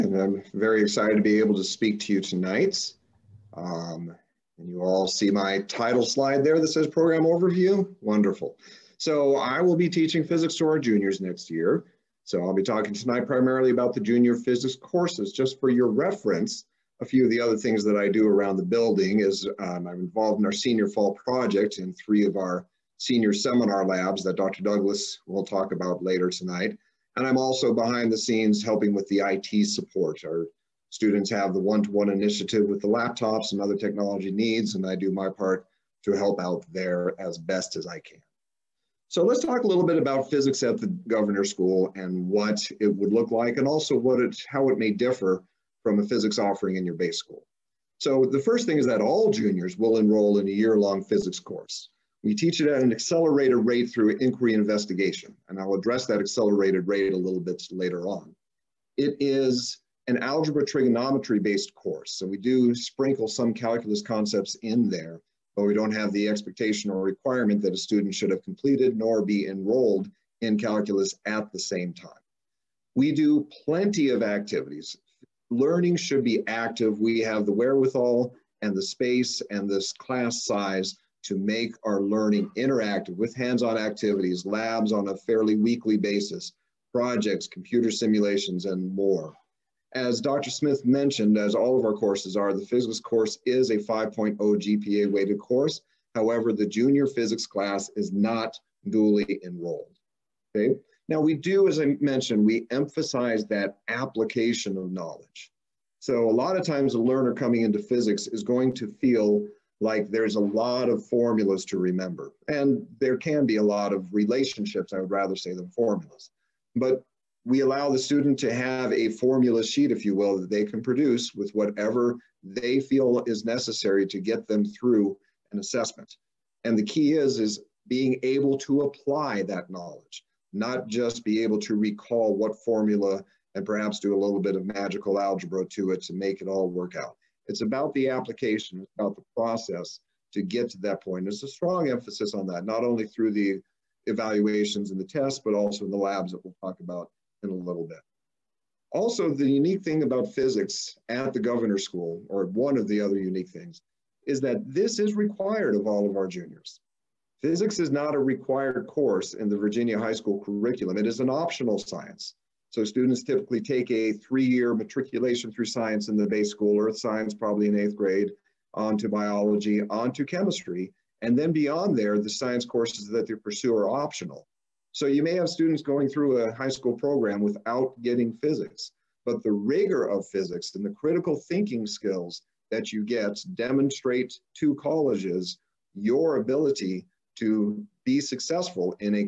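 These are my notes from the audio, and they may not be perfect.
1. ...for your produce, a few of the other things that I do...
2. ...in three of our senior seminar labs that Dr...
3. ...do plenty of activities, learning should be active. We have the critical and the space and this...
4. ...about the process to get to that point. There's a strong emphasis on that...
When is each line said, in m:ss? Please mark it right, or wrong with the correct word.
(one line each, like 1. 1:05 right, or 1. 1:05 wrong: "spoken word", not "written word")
1. 0:15 wrong: "reference", not "produce"
2. 0:21 right
3. 1:13 wrong: "wherewithal", not "critical"
4. 2:18 right.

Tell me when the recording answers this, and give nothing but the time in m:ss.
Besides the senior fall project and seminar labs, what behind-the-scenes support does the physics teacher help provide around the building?
0:29.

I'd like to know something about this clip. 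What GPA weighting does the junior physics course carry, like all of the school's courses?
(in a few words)
5.0.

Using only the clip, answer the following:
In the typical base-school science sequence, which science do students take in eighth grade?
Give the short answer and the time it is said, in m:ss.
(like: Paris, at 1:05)
earth science, at 2:46.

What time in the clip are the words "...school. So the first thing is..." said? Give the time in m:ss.
0:47.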